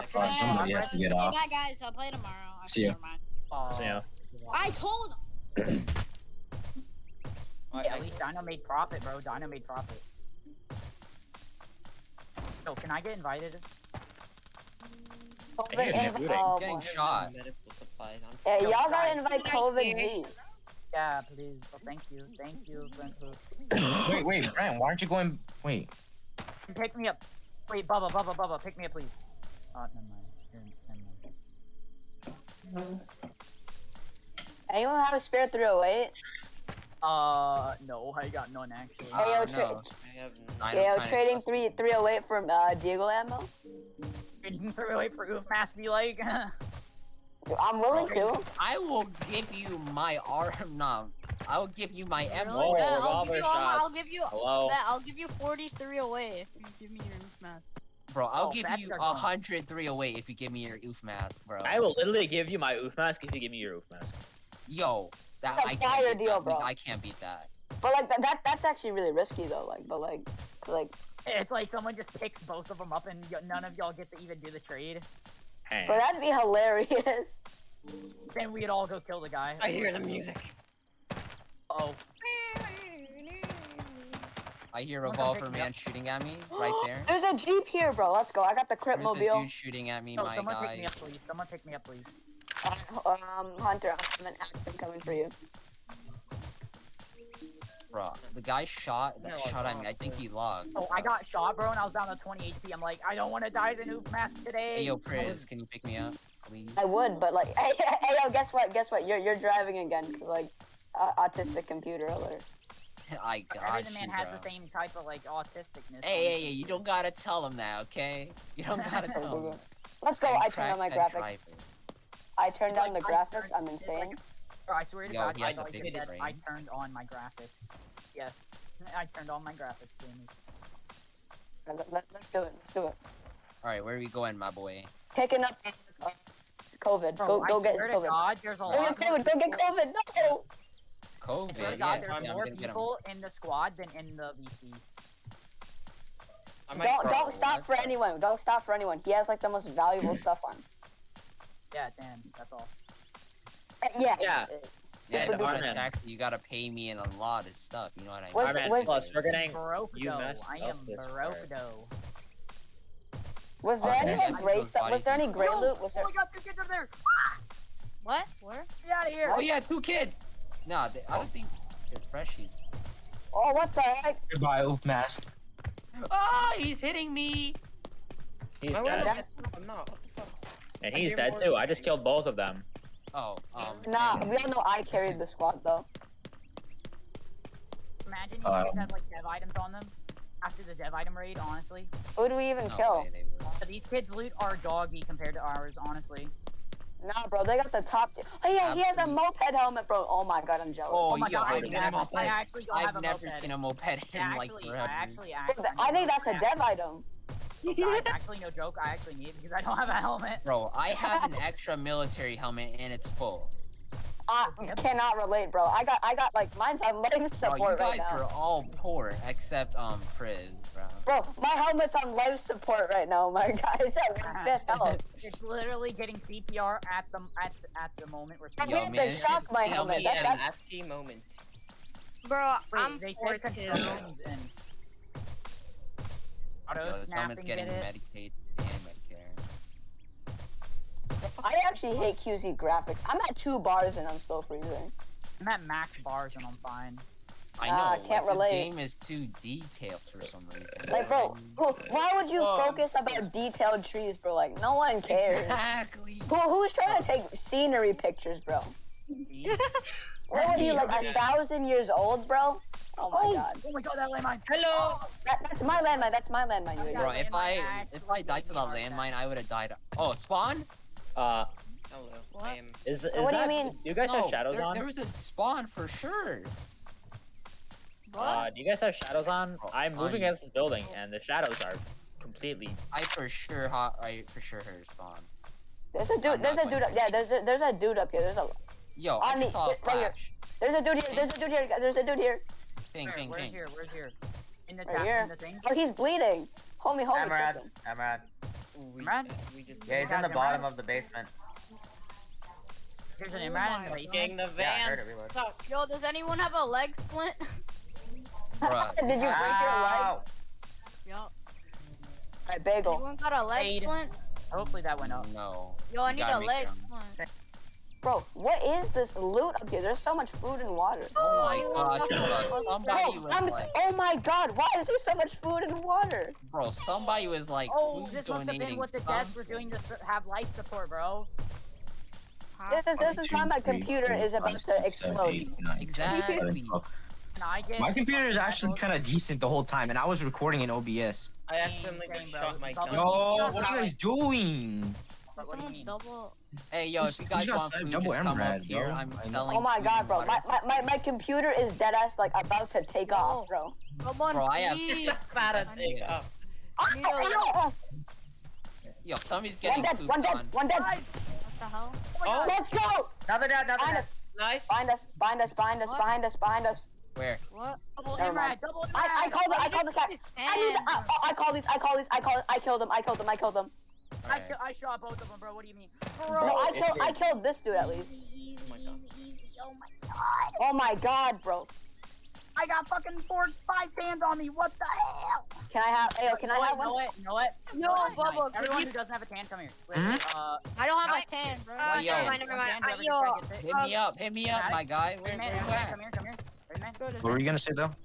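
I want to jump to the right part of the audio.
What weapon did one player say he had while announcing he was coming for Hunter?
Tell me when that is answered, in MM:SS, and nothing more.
01:34.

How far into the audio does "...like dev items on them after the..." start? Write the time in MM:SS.
03:08.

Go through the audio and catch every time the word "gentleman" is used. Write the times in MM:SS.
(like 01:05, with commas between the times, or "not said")
not said.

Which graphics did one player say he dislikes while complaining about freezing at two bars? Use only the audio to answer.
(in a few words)
QZ graphics.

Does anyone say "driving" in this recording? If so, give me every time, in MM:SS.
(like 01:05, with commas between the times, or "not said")
01:49, 02:01.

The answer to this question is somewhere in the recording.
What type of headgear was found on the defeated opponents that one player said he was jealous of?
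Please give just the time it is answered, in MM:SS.
03:19.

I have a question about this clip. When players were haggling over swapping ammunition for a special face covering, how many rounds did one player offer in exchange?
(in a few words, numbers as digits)
100.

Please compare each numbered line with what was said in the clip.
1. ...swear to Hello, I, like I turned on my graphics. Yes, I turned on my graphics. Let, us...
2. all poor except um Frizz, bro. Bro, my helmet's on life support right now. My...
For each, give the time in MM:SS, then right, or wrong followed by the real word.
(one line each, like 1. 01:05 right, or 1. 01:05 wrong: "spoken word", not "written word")
1. 02:04 wrong: "God", not "Hello"
2. 03:38 right.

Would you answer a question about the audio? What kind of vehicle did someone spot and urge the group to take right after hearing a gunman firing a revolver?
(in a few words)
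Jeep.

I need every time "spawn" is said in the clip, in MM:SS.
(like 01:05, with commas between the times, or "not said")
04:30, 04:35, 04:44.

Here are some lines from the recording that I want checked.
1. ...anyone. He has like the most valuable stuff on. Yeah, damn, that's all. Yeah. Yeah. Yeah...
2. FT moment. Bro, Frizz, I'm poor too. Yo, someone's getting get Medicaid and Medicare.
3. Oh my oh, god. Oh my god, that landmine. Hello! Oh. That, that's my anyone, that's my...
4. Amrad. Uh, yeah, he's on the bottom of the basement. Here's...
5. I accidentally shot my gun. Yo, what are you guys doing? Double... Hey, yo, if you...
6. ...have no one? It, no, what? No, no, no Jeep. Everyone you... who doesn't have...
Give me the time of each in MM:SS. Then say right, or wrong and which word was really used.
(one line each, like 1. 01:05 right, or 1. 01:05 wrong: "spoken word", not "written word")
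1. 02:28 right
2. 03:50 wrong: "Wait", not "Frizz"
3. 04:22 wrong: "landmine", not "anyone"
4. 04:58 right
5. 05:41 right
6. 06:26 wrong: "Nice", not "Jeep".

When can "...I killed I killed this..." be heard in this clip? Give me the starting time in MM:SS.
06:16.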